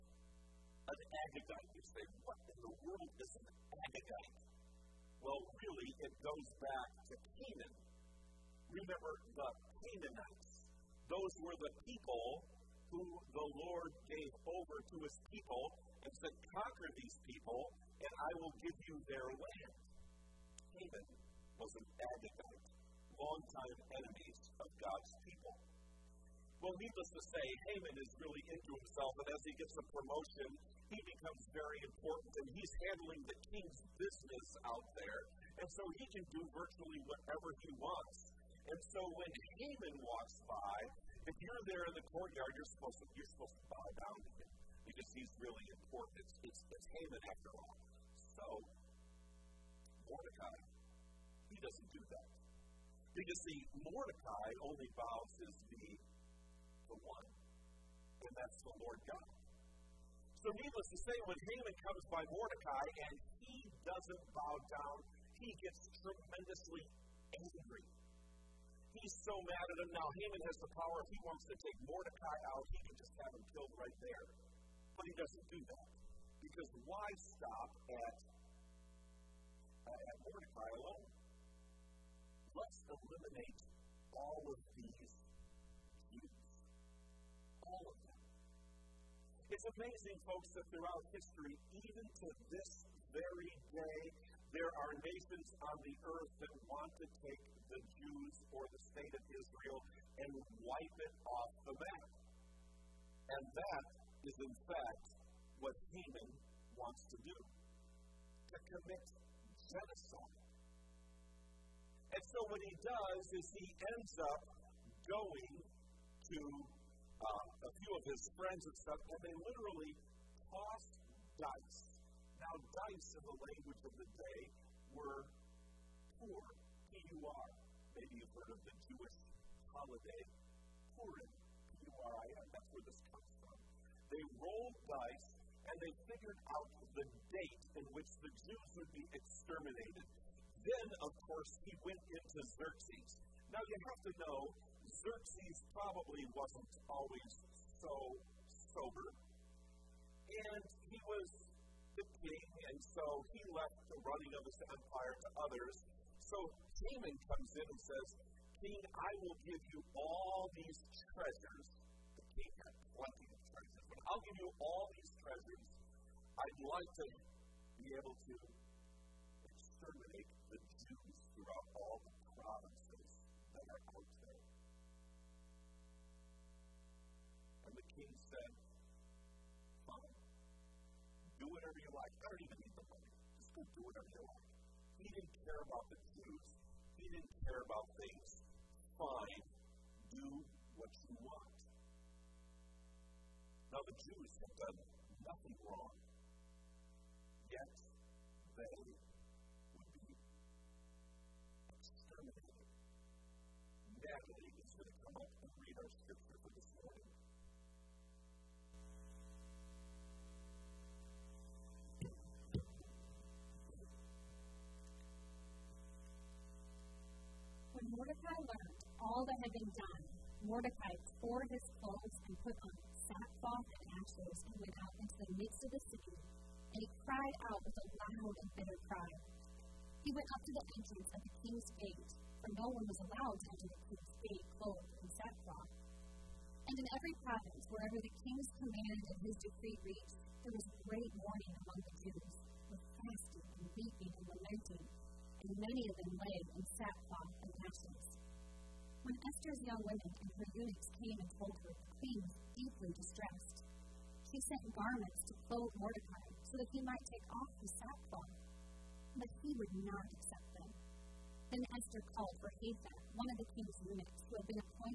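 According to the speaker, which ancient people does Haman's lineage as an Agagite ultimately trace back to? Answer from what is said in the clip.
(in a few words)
Canaanites.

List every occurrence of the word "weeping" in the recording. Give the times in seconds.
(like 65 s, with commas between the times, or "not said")
243 s.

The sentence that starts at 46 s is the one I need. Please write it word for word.
It's, it's, it's Haman after all.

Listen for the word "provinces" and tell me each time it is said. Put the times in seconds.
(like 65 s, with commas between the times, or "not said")
172 s, 237 s.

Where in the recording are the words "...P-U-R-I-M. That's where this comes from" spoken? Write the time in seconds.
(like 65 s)
131 s.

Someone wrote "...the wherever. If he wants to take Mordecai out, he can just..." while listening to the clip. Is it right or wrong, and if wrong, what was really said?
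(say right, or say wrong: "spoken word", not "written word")
wrong: "power", not "wherever".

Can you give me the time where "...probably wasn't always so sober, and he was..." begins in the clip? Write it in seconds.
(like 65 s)
145 s.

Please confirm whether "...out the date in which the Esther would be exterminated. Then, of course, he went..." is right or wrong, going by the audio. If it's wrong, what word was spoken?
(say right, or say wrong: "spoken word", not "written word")
wrong: "Jews", not "Esther".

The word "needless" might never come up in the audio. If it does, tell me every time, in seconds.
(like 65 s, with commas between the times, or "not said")
26 s, 60 s.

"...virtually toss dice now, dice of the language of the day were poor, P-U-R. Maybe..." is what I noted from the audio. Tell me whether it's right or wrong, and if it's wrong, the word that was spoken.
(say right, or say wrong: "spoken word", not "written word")
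wrong: "literally", not "virtually".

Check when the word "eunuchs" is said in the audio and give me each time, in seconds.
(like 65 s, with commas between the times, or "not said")
250 s, 263 s.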